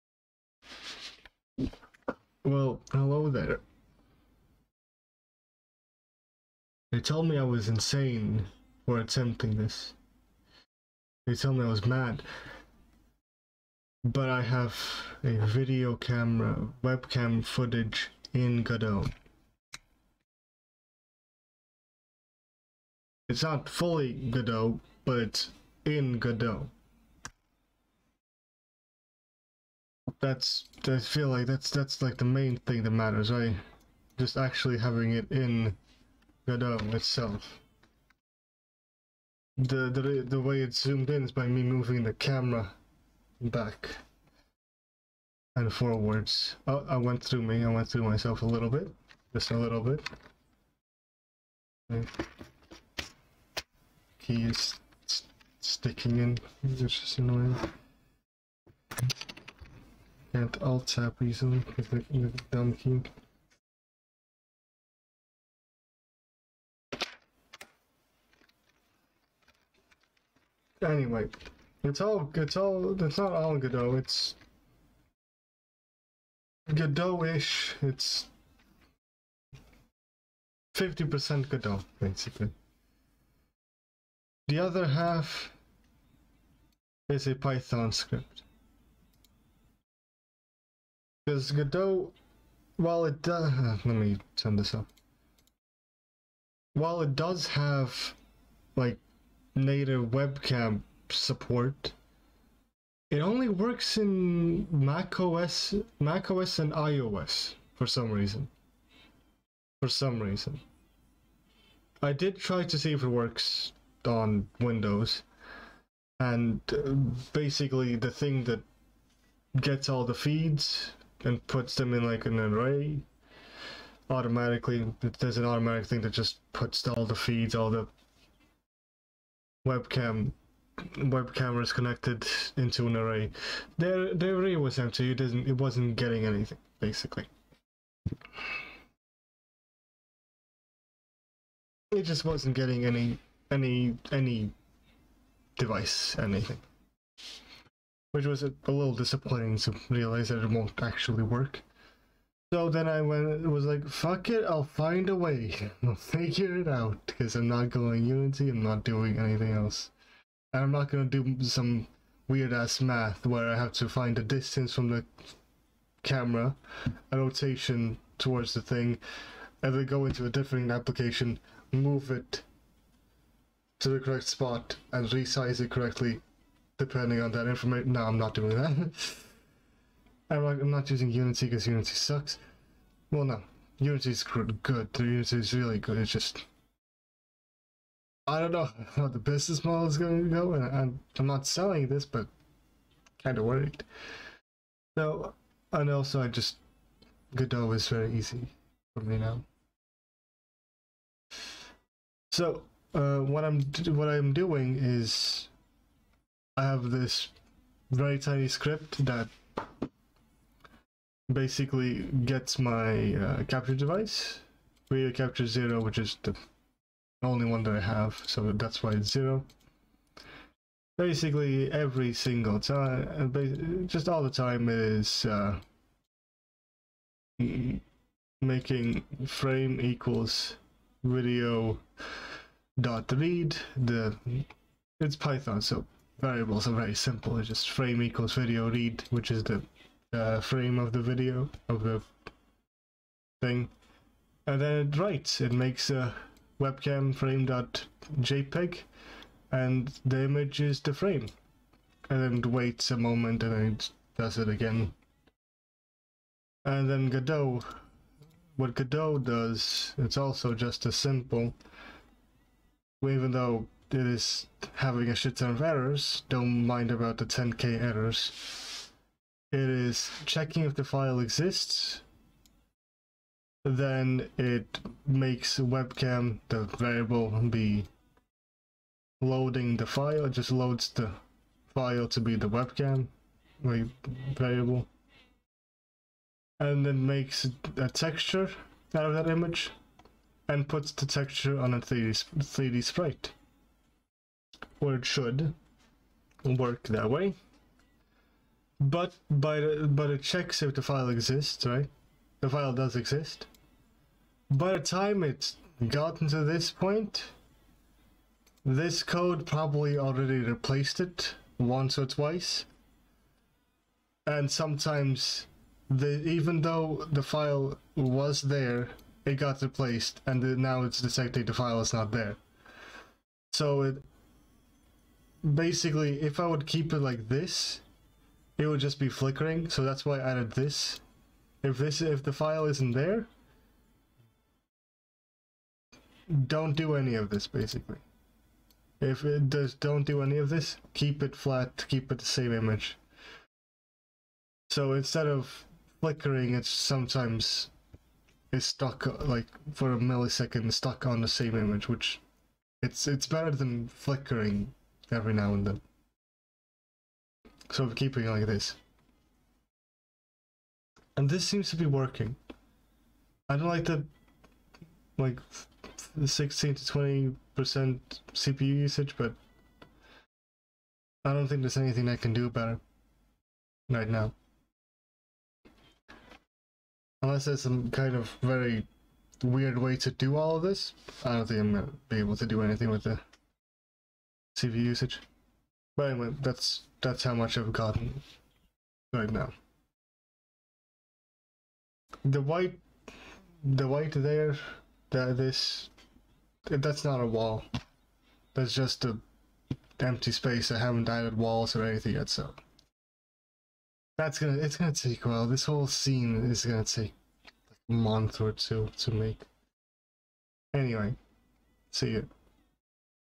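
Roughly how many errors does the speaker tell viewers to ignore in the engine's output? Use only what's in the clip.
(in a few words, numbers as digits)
10k.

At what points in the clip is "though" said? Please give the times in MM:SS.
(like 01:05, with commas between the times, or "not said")
04:23, 05:16.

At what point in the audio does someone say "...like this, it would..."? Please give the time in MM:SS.
05:26.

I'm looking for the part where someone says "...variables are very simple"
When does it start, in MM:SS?
03:56.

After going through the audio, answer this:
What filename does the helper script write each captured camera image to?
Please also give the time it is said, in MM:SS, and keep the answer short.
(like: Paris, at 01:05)
webcam frame.jpg, at 04:06.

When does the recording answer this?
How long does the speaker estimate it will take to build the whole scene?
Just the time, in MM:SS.
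06:47.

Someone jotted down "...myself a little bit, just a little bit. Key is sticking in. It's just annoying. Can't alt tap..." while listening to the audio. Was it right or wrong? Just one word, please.
right.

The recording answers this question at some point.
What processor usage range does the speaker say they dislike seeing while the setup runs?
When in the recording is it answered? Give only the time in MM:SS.
06:06.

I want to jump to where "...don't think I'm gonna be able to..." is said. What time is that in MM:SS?
06:21.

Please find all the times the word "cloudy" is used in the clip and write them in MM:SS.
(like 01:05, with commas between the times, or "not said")
not said.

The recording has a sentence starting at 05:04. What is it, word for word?
By the time it's gotten to this point, this code probably already replaced it once or twice.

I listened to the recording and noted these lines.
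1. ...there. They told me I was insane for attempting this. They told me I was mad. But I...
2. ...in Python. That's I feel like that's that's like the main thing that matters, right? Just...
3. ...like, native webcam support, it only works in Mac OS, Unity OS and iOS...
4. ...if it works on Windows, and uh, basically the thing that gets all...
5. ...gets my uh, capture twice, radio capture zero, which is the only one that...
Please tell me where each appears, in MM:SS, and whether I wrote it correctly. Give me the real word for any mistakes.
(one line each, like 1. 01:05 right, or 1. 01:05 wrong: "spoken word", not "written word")
1. 00:03 right
2. 00:25 wrong: "Godot", not "Python"
3. 01:38 wrong: "Mac", not "Unity"
4. 01:52 right
5. 03:32 wrong: "device", not "twice".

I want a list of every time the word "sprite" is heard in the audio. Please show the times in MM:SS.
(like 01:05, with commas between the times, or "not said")
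04:52.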